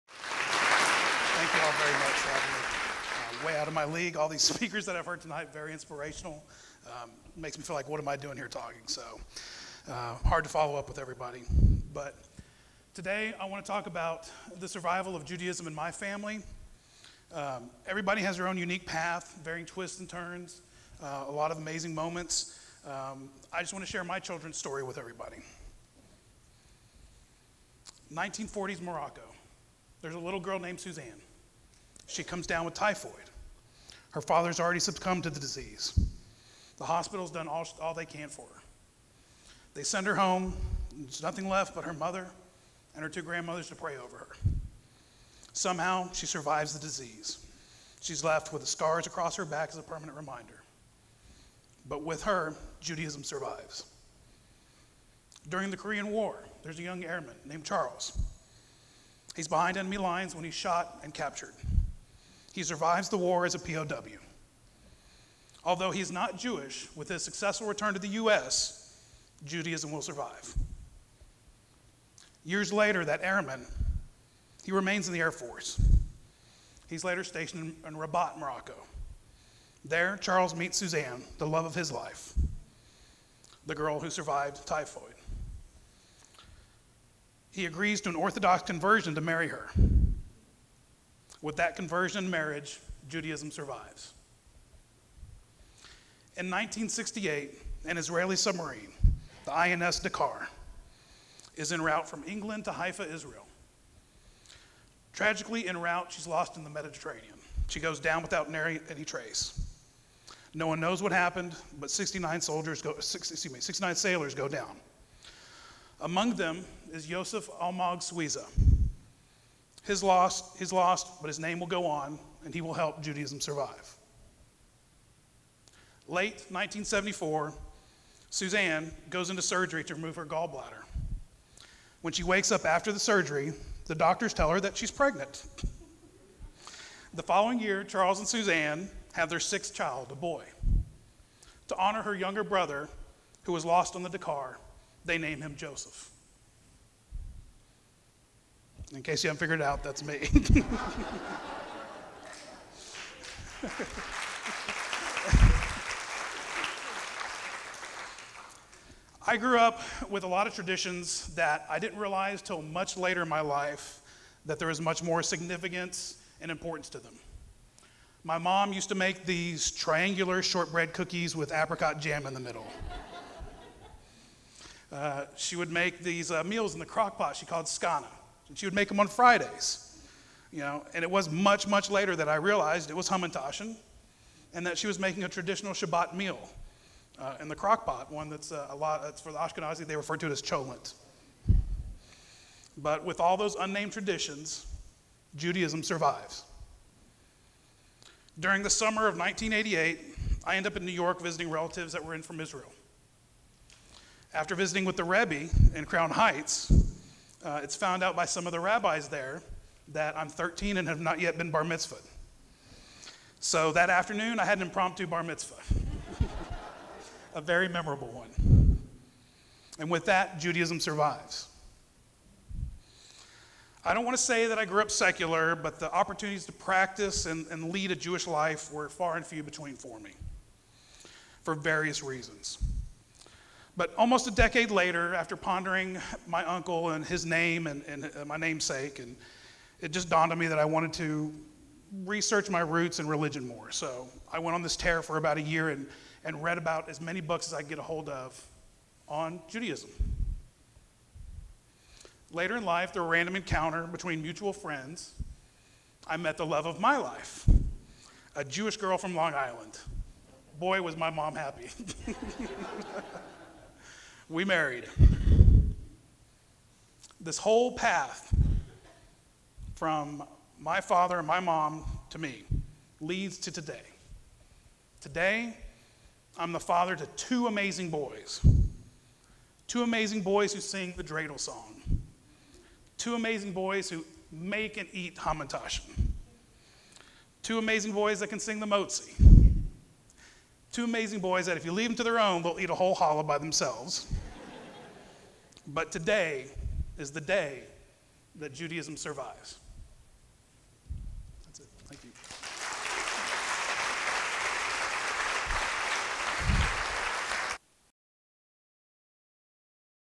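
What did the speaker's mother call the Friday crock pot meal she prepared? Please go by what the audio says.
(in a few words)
scana.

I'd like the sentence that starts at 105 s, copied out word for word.
Tragically, en route, she's lost in the Mediterranean.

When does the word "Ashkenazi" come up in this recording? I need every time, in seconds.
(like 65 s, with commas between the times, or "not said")
189 s.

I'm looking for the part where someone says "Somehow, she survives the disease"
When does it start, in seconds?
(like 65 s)
45 s.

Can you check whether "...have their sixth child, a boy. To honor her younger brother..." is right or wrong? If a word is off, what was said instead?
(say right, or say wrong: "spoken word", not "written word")
right.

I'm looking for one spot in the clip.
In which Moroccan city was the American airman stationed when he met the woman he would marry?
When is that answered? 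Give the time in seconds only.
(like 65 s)
77 s.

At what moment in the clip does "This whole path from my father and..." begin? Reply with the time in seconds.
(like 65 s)
267 s.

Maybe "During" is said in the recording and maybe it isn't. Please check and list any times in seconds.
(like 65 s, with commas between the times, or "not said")
55 s, 198 s.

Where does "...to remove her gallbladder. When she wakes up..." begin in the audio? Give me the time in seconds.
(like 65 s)
129 s.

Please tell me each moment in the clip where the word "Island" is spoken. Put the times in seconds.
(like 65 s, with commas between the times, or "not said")
259 s.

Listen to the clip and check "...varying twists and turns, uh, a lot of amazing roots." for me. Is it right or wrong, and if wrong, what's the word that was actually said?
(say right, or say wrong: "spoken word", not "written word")
wrong: "moments", not "roots".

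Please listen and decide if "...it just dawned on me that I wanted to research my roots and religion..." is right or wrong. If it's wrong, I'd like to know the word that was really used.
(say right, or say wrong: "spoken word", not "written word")
right.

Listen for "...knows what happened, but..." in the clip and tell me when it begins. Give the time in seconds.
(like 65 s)
110 s.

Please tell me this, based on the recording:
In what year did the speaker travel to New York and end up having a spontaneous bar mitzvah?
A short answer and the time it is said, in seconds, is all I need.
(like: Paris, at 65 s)
1988, at 199 s.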